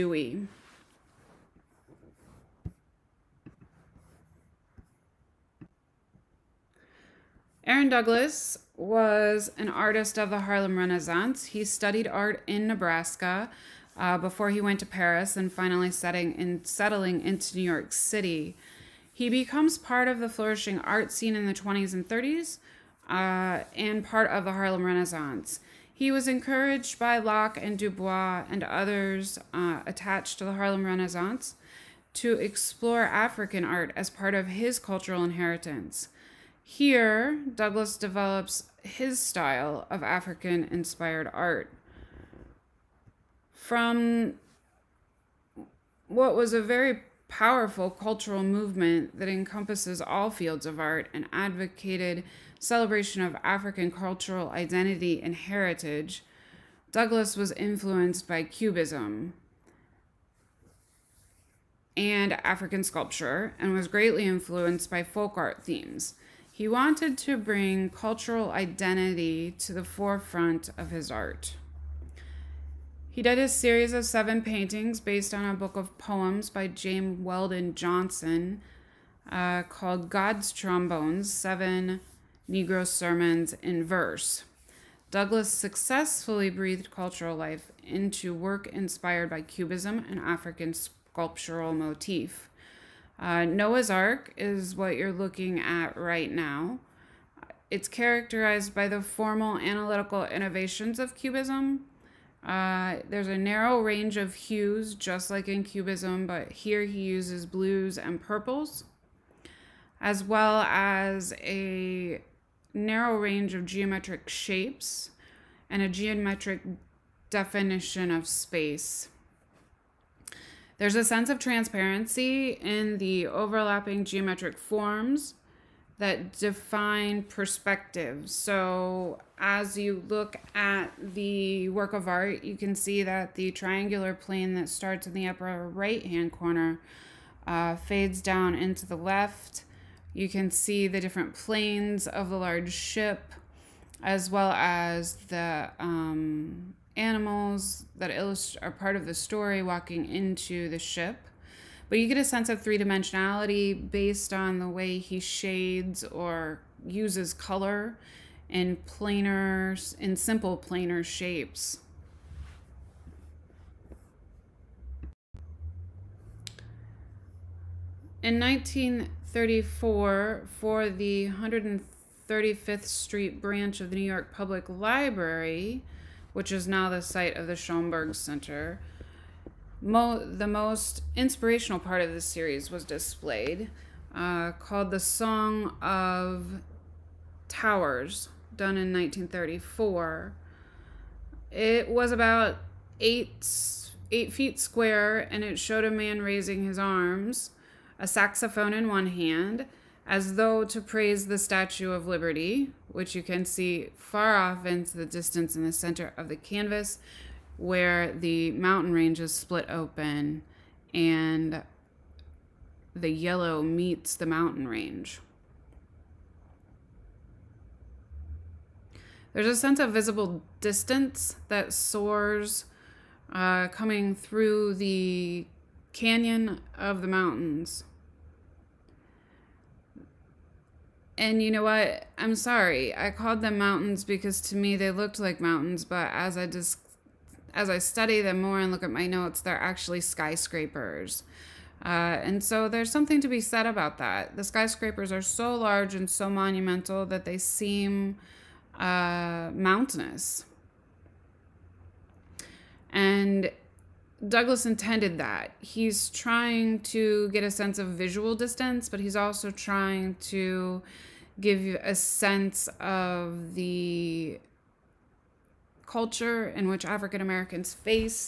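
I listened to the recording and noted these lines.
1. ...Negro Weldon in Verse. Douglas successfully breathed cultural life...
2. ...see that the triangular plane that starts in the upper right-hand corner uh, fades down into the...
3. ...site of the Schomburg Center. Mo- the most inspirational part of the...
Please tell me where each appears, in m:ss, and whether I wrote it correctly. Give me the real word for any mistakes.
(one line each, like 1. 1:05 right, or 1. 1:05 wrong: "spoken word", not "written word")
1. 1:22 wrong: "Sermons", not "Weldon"
2. 2:12 right
3. 2:56 right.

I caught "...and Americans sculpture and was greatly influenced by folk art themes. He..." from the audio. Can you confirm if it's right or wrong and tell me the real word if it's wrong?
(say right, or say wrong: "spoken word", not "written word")
wrong: "African", not "Americans".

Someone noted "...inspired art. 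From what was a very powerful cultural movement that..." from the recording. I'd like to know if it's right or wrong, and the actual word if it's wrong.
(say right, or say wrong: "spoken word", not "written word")
right.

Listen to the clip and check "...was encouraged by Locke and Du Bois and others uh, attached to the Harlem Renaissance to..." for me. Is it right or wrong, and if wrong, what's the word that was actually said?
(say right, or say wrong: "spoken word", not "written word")
right.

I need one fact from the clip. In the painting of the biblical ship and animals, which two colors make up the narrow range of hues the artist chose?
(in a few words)
Blues and purples.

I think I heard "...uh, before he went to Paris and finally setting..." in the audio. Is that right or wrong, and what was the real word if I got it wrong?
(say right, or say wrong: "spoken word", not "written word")
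right.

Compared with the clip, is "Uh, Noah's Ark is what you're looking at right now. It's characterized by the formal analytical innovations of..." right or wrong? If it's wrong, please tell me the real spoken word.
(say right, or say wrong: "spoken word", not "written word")
right.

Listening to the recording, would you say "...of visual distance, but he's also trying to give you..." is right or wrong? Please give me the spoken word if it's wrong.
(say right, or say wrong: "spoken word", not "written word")
right.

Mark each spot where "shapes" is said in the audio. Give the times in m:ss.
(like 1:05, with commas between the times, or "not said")
1:54, 2:41.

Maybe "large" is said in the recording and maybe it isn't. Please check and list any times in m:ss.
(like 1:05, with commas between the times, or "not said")
2:22, 4:05.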